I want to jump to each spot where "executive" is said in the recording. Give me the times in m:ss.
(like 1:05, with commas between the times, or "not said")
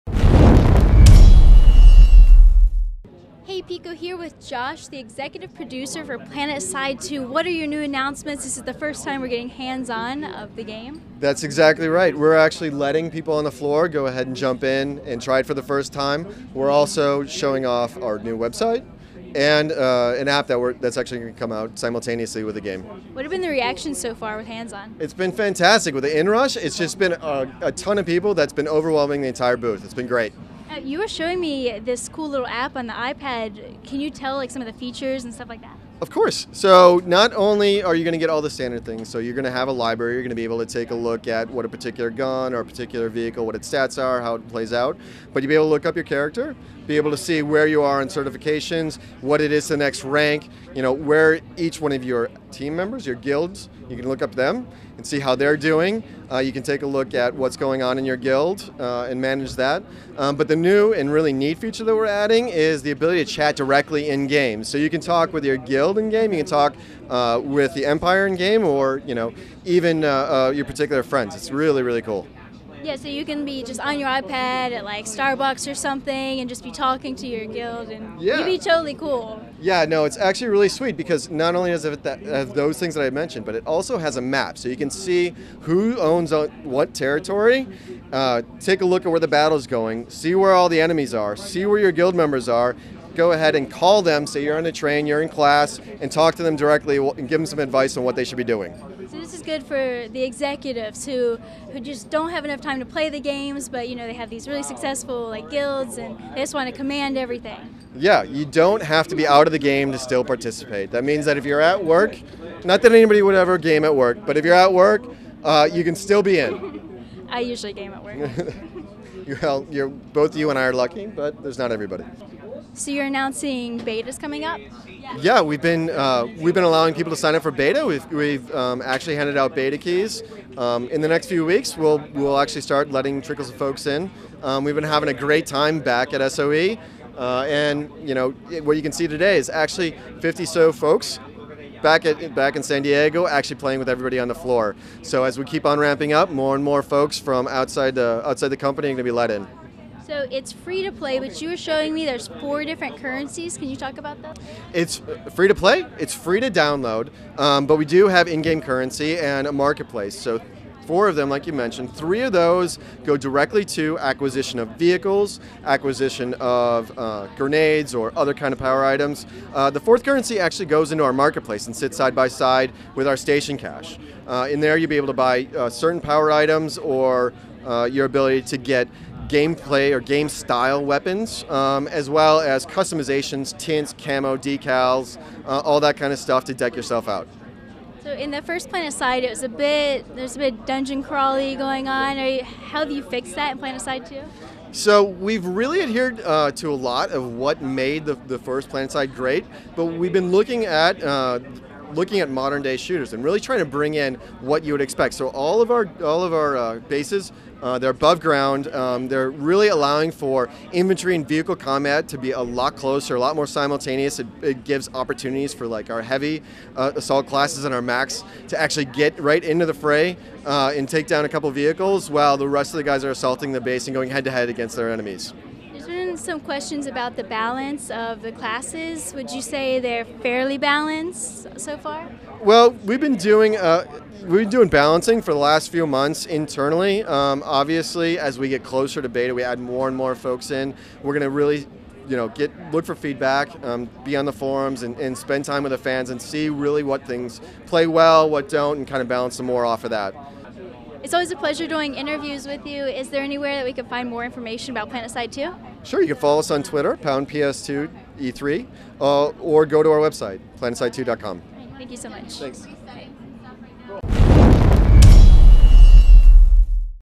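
0:04, 1:40.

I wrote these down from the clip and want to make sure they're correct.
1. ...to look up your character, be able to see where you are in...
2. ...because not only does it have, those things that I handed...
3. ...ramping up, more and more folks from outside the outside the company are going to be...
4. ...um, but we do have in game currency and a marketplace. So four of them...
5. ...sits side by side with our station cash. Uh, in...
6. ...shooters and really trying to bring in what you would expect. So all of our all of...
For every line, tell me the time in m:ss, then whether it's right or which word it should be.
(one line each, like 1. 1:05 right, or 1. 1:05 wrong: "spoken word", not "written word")
1. 0:45 right
2. 1:20 wrong: "mentioned", not "handed"
3. 2:25 right
4. 2:37 right
5. 2:51 right
6. 3:22 right.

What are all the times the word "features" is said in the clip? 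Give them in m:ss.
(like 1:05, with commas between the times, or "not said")
0:34, 1:01.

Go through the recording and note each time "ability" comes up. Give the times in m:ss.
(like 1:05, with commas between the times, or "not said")
1:02, 2:58.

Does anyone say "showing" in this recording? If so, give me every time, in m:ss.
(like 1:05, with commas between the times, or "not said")
0:17, 0:31, 2:31.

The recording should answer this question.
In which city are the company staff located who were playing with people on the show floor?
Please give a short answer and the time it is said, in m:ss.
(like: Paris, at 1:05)
San Diego, at 2:22.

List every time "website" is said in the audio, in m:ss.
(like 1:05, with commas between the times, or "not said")
0:18, 4:19.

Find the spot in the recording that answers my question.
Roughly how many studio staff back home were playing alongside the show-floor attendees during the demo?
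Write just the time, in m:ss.
2:20.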